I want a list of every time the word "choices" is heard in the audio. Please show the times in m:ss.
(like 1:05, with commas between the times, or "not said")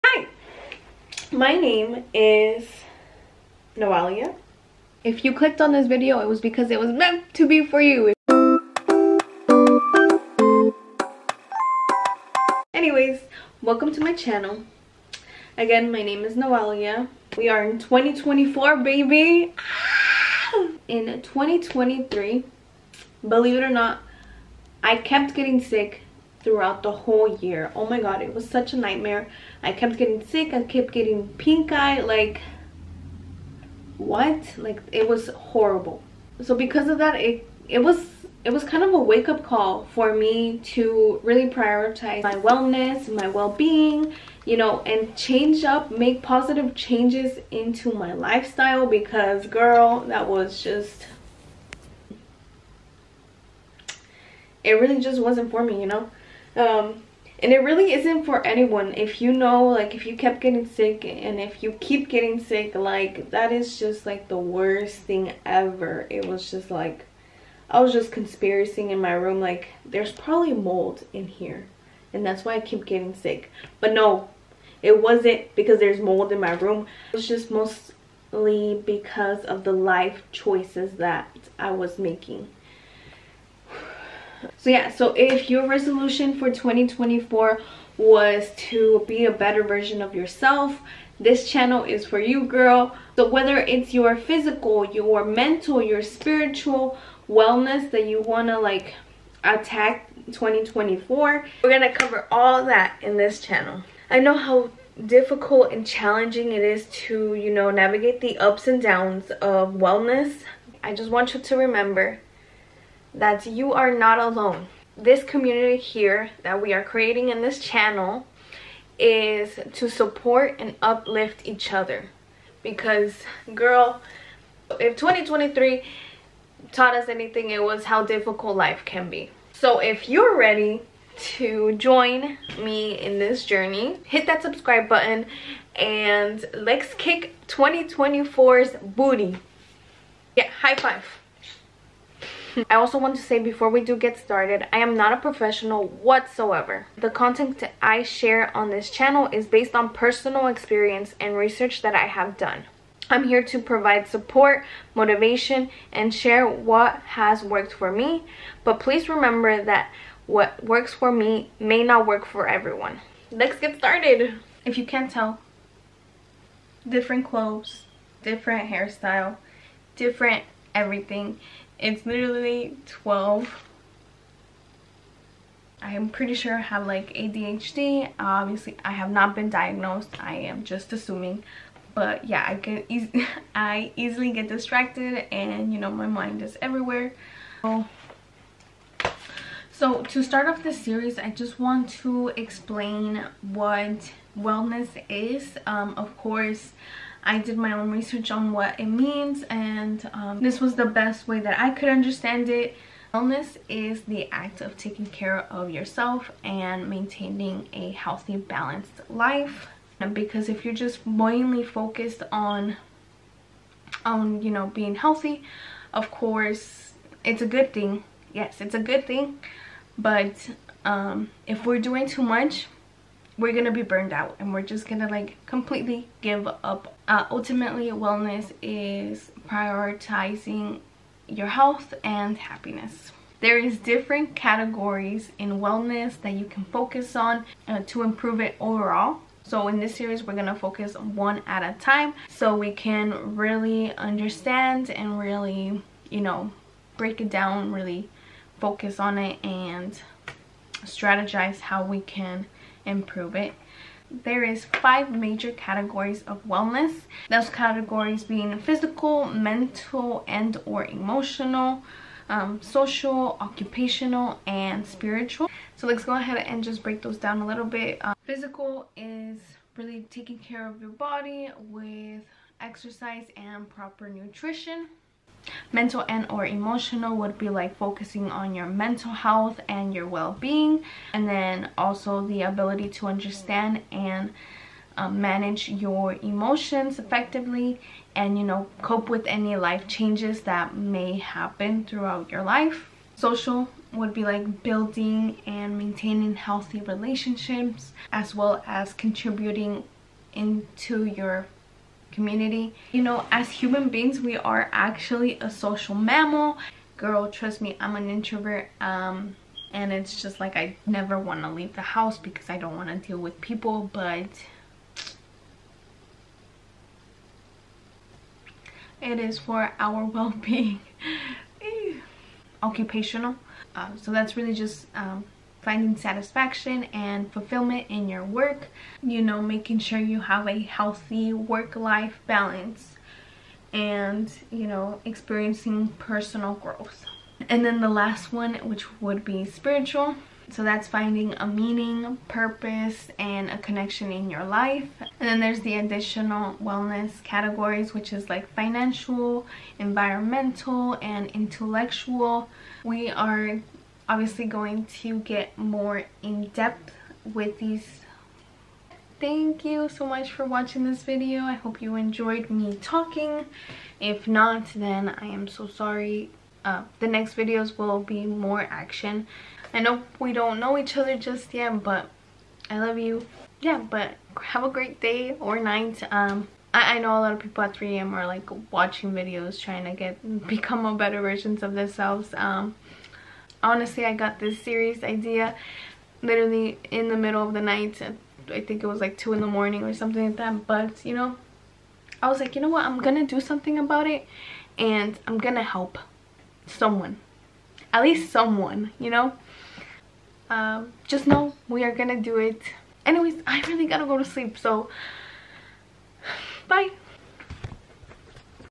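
1:20.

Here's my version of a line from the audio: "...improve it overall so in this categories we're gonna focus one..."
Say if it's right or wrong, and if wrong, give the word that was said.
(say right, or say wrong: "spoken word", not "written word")
wrong: "series", not "categories".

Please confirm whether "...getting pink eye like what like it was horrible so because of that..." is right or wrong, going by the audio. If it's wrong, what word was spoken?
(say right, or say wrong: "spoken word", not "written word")
right.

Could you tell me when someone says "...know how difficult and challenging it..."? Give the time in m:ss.
1:44.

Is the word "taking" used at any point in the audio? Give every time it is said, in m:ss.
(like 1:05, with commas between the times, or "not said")
3:24, 4:30.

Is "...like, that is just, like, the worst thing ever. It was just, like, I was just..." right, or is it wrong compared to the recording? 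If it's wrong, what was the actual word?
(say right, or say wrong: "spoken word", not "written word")
right.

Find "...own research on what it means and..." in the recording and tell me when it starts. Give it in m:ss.
3:17.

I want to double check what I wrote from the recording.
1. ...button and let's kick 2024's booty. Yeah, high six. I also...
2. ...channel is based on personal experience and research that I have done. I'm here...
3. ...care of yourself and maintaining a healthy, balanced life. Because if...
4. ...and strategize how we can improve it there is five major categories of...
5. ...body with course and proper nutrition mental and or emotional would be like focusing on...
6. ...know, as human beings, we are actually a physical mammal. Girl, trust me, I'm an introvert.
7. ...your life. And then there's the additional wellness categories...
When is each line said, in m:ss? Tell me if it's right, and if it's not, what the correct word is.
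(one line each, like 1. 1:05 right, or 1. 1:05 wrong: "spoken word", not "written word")
1. 2:14 wrong: "five", not "six"
2. 2:28 right
3. 3:25 right
4. 4:09 right
5. 4:30 wrong: "exercise", not "course"
6. 5:03 wrong: "social", not "physical"
7. 5:44 right.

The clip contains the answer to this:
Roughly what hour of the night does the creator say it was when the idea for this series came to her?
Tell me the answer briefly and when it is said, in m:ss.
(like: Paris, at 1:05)
2 in the morning, at 6:29.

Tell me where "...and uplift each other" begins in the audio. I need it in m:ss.
2:00.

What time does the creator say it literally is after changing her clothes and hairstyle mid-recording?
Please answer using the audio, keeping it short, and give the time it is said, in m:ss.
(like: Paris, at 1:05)
12, at 2:52.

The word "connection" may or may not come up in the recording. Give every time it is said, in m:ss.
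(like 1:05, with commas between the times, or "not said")
5:43.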